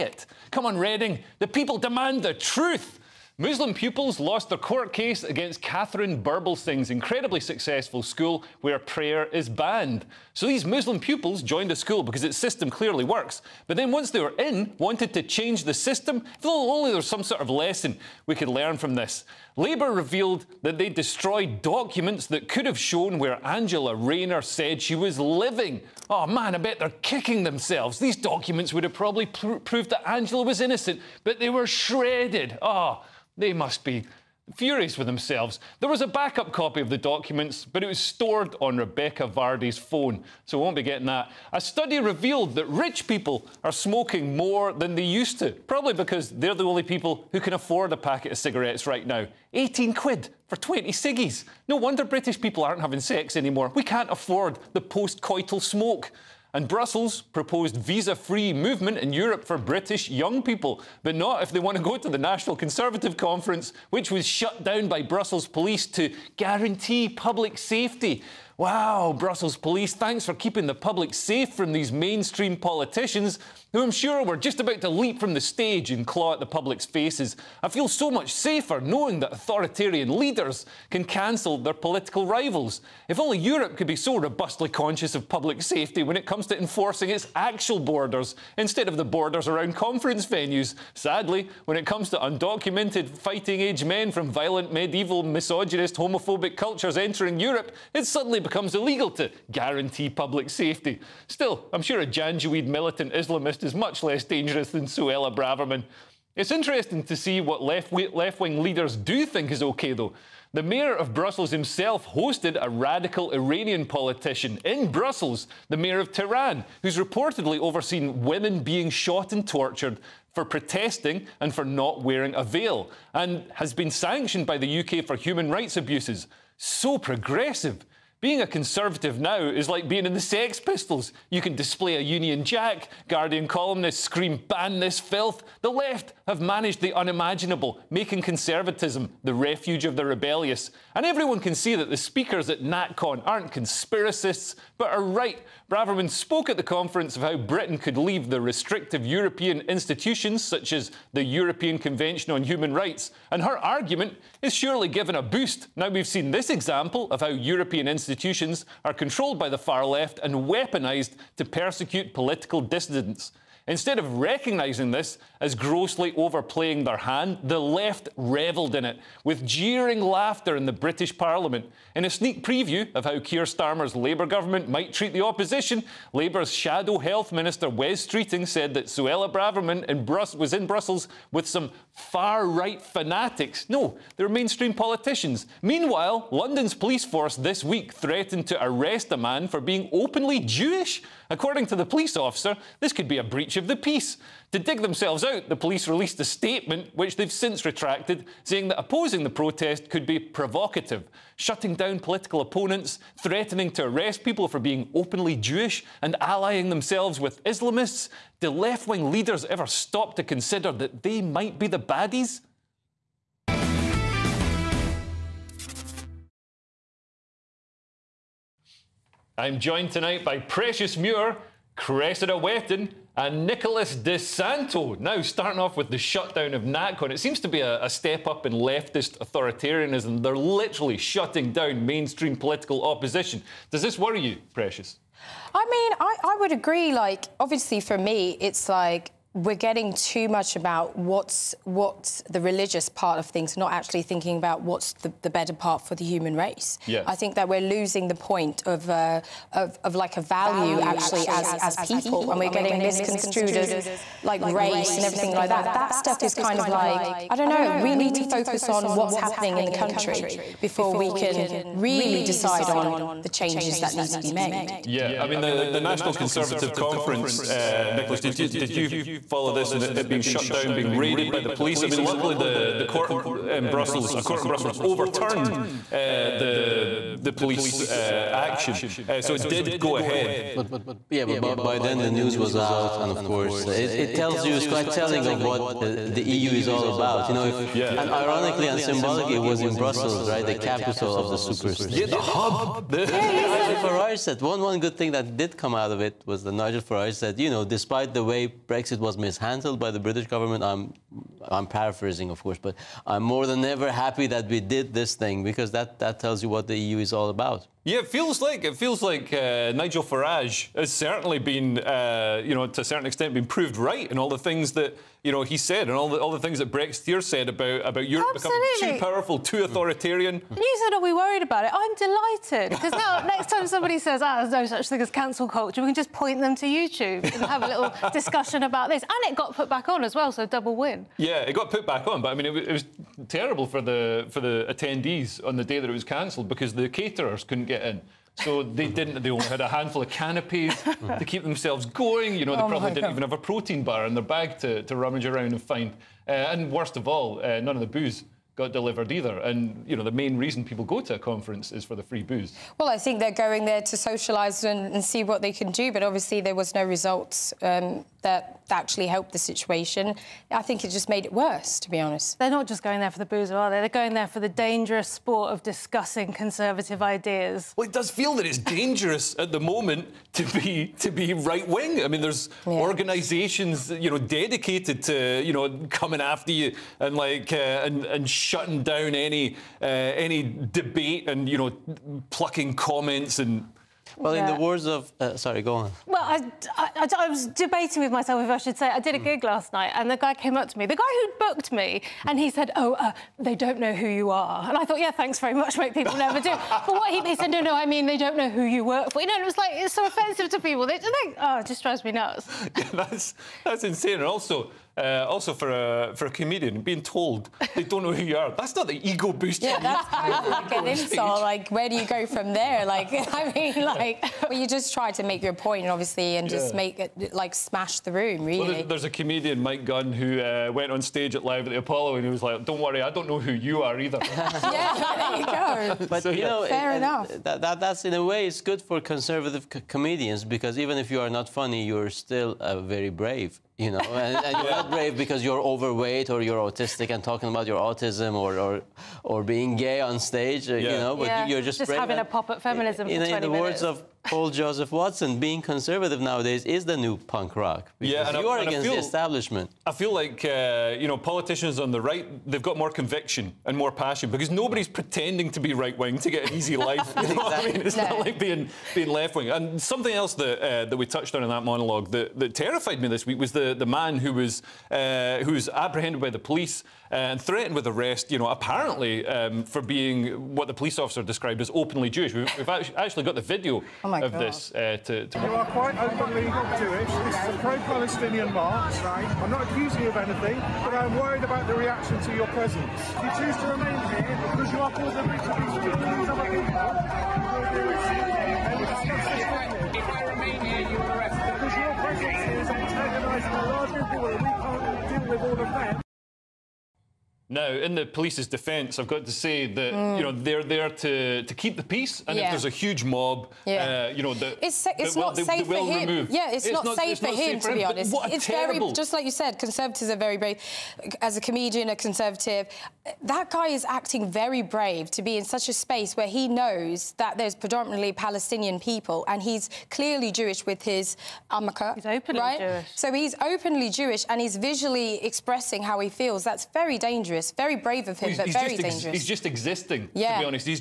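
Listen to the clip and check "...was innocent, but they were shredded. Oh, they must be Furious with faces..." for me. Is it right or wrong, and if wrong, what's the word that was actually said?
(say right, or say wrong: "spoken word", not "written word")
wrong: "themselves", not "faces".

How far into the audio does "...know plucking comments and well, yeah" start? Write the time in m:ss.
6:21.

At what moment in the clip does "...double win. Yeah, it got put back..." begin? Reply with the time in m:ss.
5:30.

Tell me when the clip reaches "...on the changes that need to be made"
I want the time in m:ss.
4:22.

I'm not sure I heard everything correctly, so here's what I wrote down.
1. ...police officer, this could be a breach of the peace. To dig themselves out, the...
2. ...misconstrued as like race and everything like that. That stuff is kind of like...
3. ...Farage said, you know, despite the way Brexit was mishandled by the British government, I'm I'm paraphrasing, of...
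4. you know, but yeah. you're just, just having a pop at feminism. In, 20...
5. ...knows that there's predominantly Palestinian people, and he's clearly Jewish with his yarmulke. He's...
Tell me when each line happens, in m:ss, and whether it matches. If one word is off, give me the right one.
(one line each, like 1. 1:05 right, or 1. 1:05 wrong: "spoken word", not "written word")
1. 3:11 right
2. 4:12 right
3. 4:56 right
4. 7:20 right
5. 8:36 right.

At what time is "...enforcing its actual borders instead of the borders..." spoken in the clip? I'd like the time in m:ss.
1:26.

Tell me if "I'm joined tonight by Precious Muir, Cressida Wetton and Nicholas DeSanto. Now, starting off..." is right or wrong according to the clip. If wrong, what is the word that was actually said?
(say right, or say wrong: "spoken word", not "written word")
right.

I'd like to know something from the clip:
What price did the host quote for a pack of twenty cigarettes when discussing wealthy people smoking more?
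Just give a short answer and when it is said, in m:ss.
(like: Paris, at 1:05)
18 quid, at 0:49.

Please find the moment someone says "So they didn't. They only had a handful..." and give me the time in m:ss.
5:38.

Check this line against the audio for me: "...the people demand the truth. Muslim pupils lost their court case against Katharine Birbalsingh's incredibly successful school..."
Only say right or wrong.
right.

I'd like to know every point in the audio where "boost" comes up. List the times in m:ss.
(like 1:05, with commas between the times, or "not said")
2:35, 6:49.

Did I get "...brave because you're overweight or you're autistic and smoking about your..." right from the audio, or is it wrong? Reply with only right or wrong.
wrong.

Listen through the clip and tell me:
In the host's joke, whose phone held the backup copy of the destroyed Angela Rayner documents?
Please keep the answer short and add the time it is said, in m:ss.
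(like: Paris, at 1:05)
Rebekah Vardy, at 0:38.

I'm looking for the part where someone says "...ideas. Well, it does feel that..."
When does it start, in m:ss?
6:07.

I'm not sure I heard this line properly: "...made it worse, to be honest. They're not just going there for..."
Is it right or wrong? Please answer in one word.
right.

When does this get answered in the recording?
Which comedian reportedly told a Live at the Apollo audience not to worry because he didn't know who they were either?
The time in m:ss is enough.
6:59.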